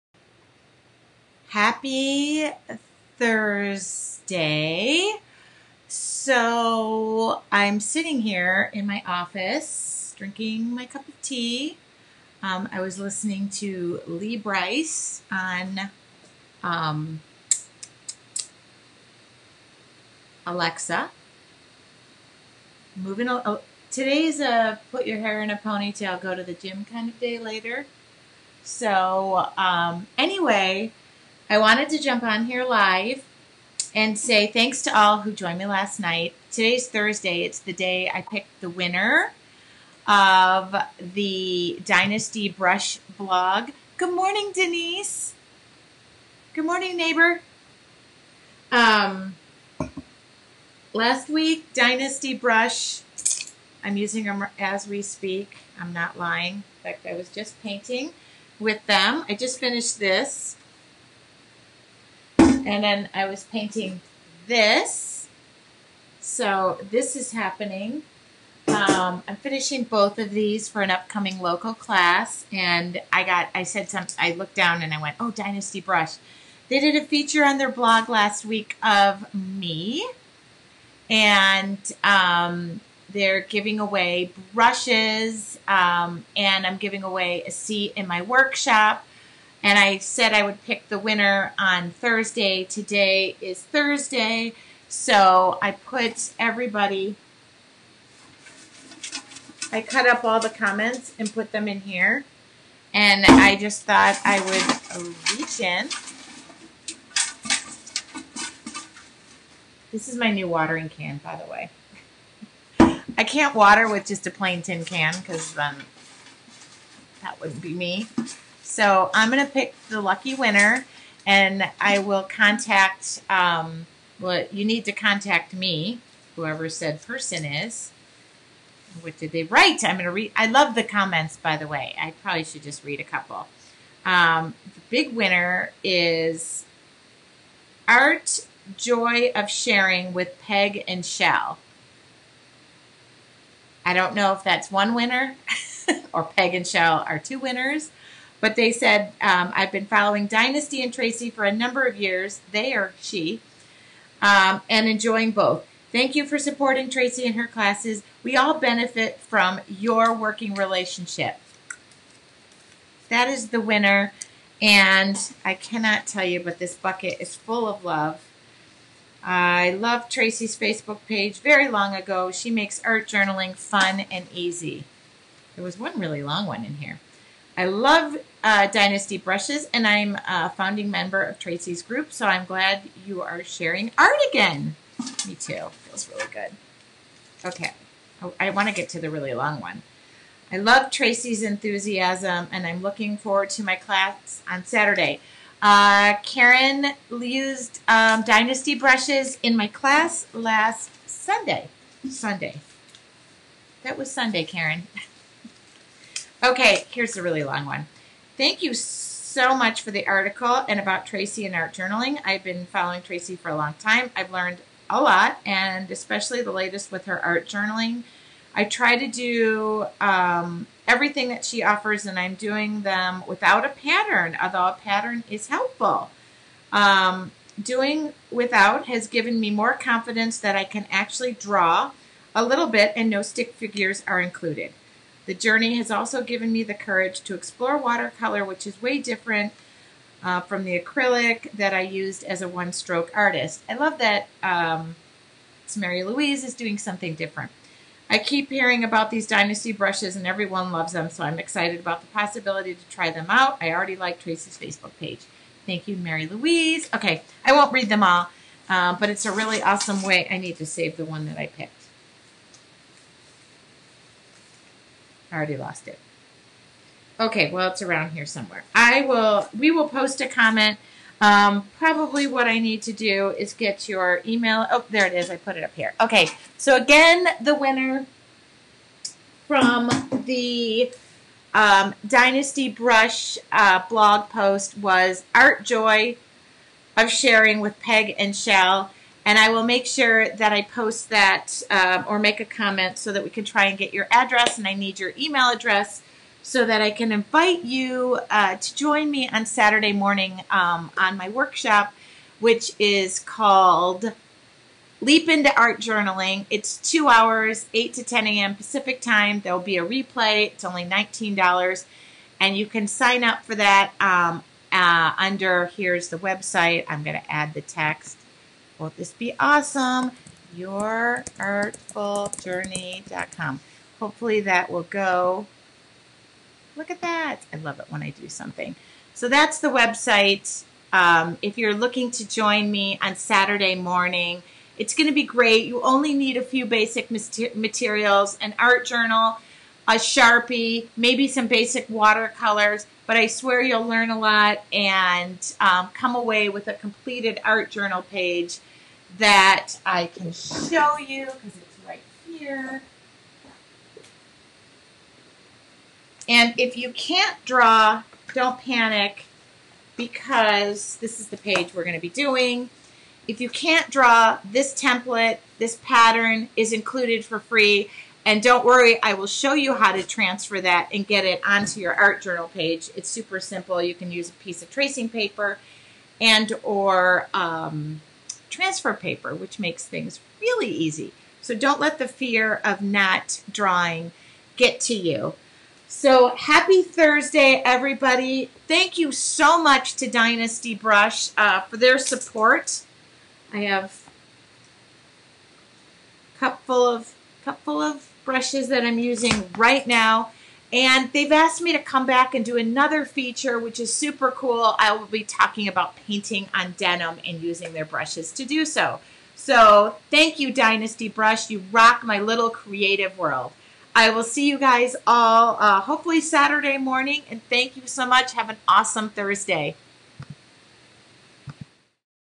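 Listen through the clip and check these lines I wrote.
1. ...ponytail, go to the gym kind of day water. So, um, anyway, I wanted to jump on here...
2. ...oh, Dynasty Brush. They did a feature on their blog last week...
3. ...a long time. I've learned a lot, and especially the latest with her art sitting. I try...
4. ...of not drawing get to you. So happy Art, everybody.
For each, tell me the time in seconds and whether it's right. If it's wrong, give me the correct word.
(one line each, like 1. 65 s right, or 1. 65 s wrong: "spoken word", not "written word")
1. 25 s wrong: "later", not "water"
2. 75 s right
3. 213 s wrong: "journaling", not "sitting"
4. 382 s wrong: "Thursday", not "Art".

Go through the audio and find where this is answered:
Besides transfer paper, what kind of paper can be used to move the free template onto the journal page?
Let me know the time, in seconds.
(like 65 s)
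374 s.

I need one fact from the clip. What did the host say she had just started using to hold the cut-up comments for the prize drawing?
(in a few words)
watering can.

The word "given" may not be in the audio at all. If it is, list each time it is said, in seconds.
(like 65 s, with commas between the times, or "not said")
229 s, 236 s.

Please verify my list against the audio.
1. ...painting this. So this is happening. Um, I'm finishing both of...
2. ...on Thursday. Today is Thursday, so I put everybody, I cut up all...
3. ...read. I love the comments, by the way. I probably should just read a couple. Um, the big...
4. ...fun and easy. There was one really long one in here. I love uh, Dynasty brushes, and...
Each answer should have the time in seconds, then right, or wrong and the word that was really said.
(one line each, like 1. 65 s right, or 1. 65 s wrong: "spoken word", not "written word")
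1. 63 s right
2. 91 s right
3. 130 s right
4. 173 s right.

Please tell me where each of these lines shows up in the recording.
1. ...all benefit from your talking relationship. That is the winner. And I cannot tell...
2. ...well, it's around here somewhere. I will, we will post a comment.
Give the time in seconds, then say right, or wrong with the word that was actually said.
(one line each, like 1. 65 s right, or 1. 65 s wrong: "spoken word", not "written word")
1. 158 s wrong: "working", not "talking"
2. 267 s right.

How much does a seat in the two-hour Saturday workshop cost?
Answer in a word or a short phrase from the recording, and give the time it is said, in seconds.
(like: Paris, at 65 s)
$19, at 310 s.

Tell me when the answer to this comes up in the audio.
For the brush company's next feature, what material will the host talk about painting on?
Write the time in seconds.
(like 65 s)
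406 s.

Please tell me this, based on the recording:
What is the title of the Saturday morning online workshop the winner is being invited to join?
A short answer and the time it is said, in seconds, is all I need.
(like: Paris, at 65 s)
Leap into Art Journaling, at 305 s.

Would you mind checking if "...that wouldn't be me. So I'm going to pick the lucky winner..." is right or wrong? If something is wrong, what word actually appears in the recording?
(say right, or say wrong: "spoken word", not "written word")
right.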